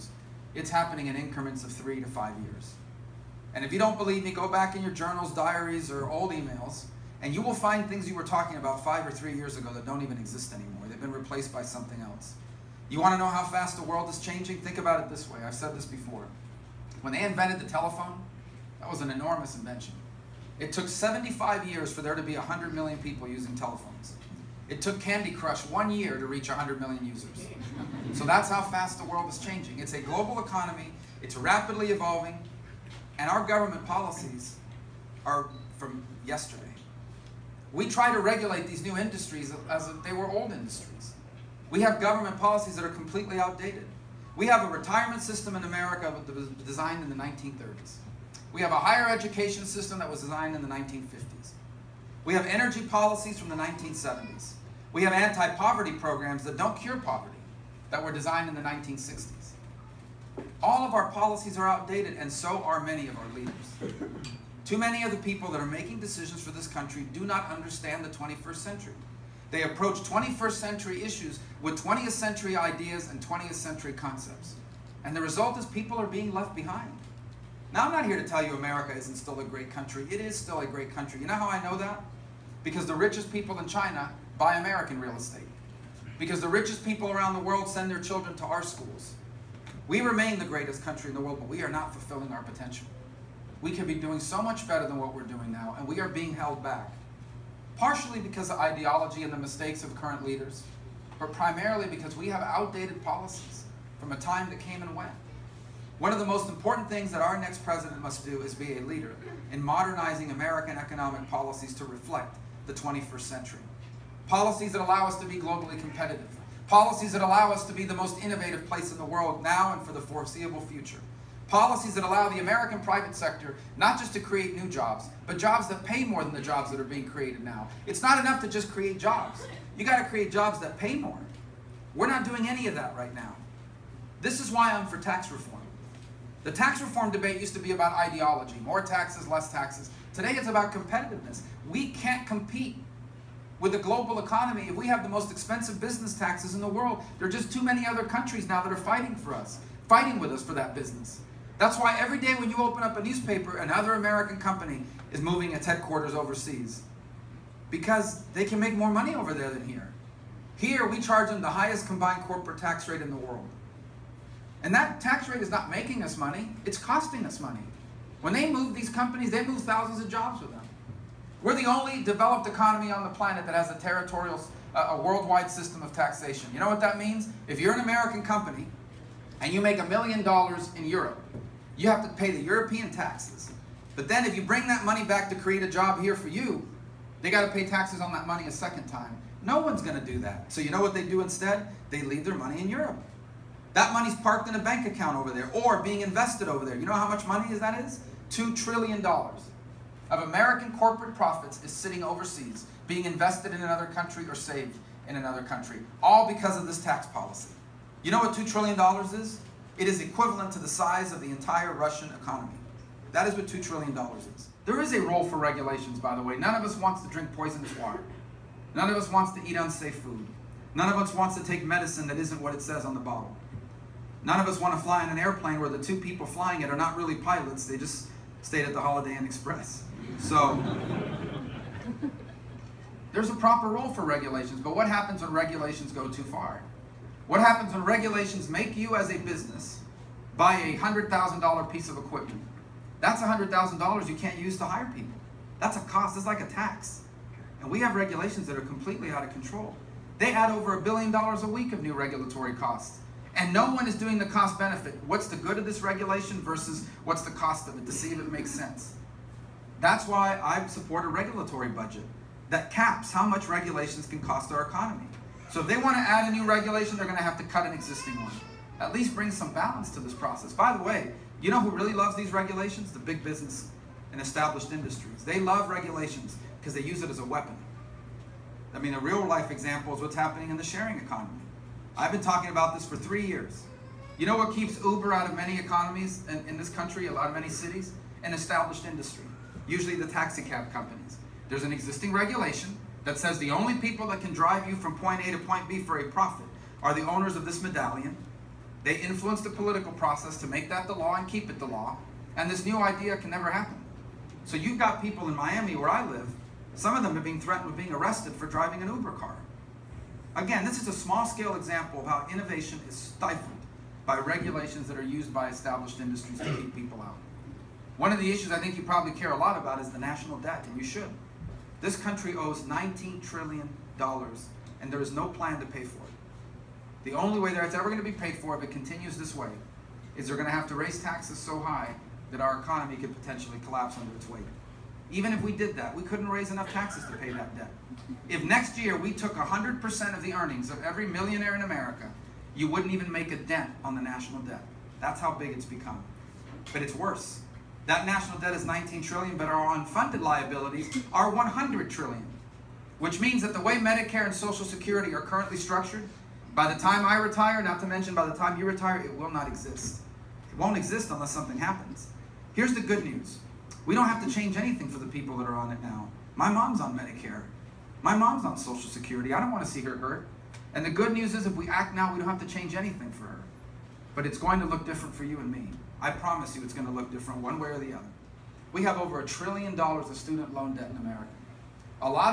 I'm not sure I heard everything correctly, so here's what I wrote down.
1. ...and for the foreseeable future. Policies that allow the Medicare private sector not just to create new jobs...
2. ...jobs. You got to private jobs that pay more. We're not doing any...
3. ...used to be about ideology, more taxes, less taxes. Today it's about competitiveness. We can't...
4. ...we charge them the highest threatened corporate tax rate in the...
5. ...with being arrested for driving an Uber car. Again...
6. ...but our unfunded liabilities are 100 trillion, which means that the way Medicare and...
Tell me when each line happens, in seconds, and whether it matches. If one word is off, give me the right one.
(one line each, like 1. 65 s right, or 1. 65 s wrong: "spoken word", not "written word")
1. 119 s wrong: "American", not "Medicare"
2. 128 s wrong: "create", not "private"
3. 137 s right
4. 160 s wrong: "combined", not "threatened"
5. 307 s right
6. 349 s right.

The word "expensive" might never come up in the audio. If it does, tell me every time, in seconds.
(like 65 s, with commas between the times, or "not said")
145 s.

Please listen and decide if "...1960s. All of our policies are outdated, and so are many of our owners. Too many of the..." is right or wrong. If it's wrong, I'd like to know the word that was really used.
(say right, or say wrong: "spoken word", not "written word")
wrong: "leaders", not "owners".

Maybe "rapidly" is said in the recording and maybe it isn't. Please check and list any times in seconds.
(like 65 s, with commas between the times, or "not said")
31 s.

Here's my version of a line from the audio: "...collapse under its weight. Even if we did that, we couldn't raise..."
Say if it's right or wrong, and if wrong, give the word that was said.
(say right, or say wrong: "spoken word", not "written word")
right.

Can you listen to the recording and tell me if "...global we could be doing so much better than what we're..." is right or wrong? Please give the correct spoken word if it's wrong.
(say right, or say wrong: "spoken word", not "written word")
wrong: "potential", not "global".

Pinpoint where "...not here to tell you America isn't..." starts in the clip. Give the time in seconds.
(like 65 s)
77 s.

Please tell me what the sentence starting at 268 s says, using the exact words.
At least bring some balance to this process.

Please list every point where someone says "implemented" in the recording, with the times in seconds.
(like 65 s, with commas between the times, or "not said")
not said.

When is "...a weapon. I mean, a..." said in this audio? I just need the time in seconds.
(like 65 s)
277 s.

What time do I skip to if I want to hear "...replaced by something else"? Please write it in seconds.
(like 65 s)
11 s.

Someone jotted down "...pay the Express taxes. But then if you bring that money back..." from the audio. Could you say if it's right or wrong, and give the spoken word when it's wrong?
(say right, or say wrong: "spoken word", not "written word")
wrong: "European", not "Express".